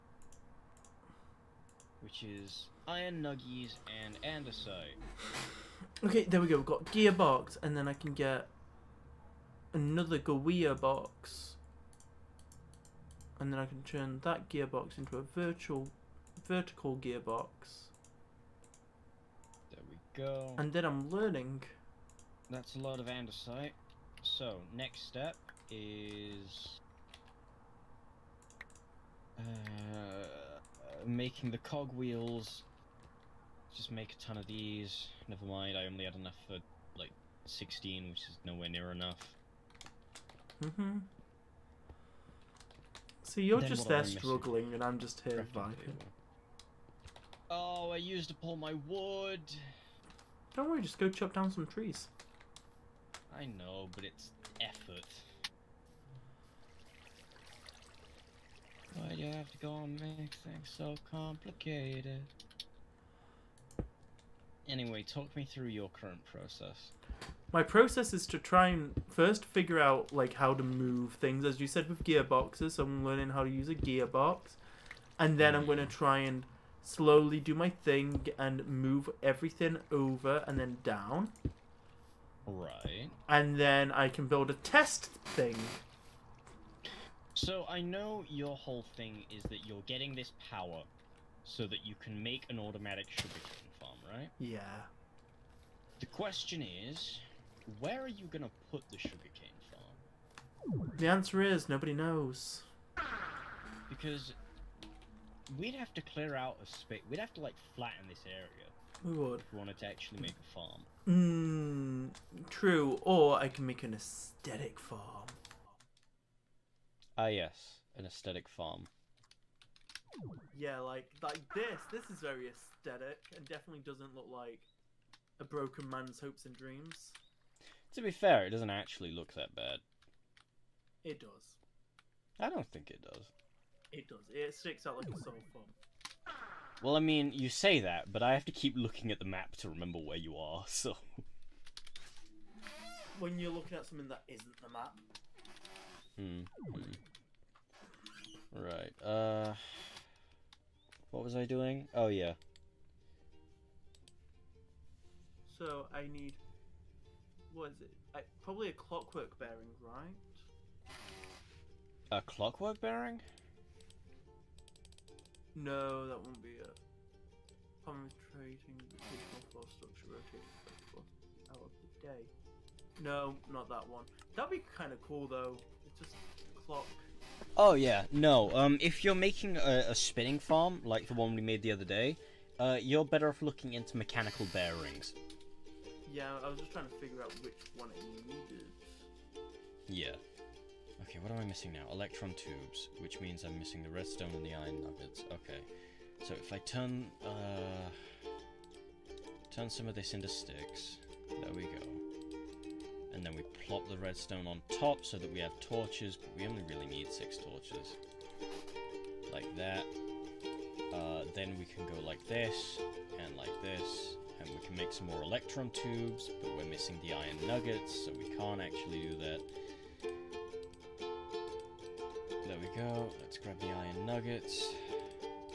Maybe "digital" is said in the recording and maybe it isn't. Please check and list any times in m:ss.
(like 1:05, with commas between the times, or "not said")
2:48.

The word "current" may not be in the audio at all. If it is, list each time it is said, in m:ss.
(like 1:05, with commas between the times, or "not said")
1:05.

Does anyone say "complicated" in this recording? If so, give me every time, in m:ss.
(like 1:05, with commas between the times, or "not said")
1:01.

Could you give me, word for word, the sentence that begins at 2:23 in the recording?
When you're looking at something that isn't the map.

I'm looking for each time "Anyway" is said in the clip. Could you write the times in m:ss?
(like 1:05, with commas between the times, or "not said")
1:04.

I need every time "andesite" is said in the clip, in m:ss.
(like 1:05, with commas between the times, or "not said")
0:04, 0:23.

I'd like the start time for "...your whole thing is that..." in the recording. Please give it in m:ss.
1:28.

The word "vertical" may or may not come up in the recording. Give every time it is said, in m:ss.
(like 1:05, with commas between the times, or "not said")
0:16.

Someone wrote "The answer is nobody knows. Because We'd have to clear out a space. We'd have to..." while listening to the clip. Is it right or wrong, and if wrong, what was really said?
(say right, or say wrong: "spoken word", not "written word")
right.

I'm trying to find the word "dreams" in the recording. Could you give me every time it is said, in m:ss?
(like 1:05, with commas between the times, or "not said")
2:06.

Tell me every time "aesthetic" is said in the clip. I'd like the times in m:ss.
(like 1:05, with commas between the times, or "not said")
1:53, 1:58, 2:02.